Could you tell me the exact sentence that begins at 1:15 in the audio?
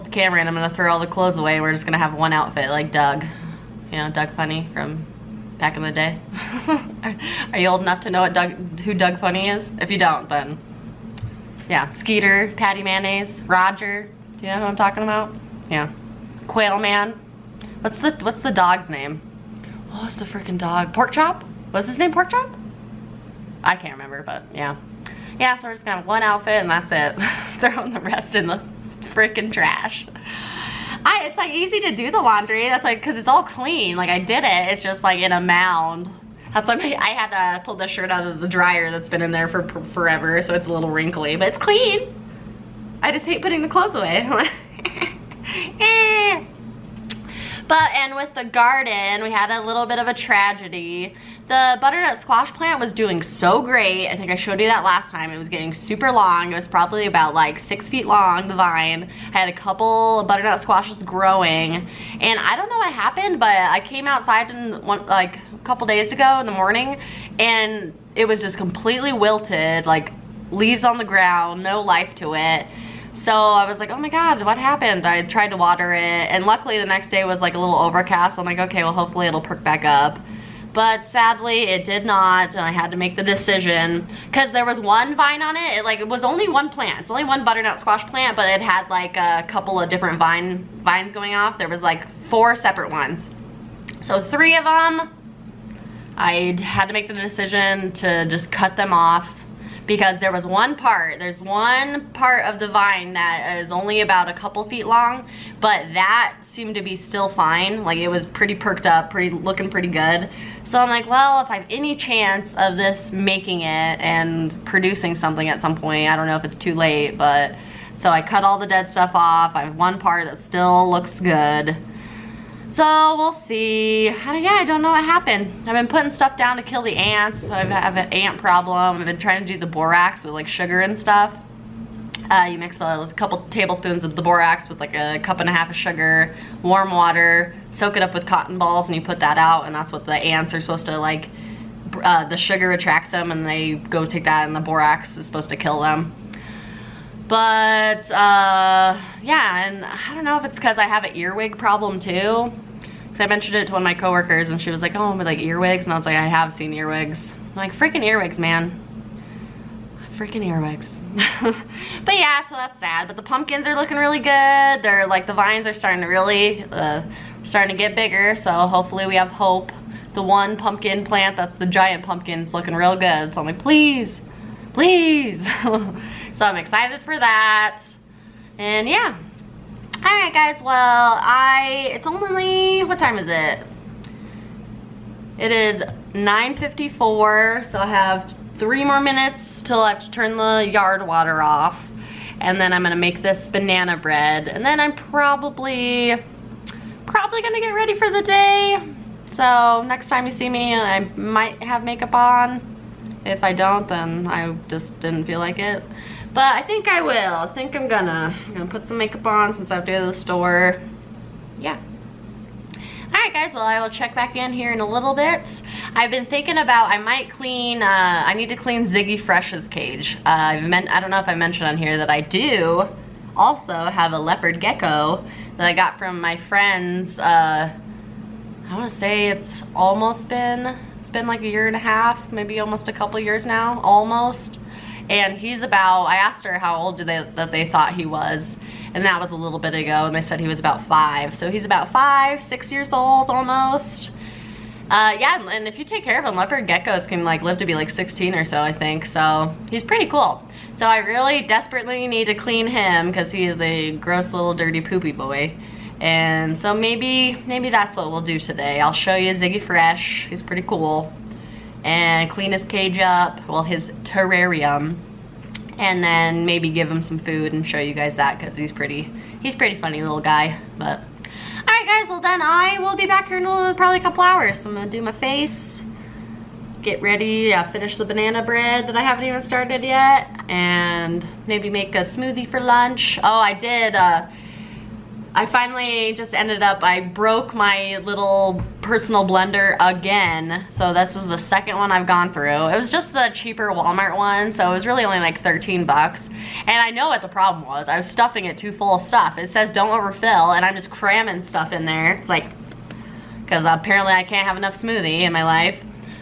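I tried to water it and luckily the next day was like a little overcast.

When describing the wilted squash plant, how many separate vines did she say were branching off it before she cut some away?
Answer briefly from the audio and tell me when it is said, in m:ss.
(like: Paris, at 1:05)
4, at 1:32.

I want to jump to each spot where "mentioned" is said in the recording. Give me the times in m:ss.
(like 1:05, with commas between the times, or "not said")
2:33, 3:41.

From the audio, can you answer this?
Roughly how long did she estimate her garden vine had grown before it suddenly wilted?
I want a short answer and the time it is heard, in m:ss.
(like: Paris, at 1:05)
6 feet, at 0:57.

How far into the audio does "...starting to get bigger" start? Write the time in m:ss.
2:47.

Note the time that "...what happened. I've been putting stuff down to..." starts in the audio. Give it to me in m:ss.
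2:04.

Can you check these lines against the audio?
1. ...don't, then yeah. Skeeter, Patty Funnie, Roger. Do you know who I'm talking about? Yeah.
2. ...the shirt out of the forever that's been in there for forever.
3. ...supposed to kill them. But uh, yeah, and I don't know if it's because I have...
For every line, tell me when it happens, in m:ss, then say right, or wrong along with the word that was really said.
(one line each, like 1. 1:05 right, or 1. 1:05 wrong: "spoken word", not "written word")
1. 0:09 wrong: "Mayonnaise", not "Funnie"
2. 0:37 wrong: "dryer", not "forever"
3. 2:25 right.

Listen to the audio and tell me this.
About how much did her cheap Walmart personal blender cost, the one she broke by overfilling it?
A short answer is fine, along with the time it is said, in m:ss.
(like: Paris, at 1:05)
$13, at 4:55.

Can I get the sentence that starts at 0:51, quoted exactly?
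The butternut squash plant was doing so great.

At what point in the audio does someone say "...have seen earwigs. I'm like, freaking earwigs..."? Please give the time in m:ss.
2:36.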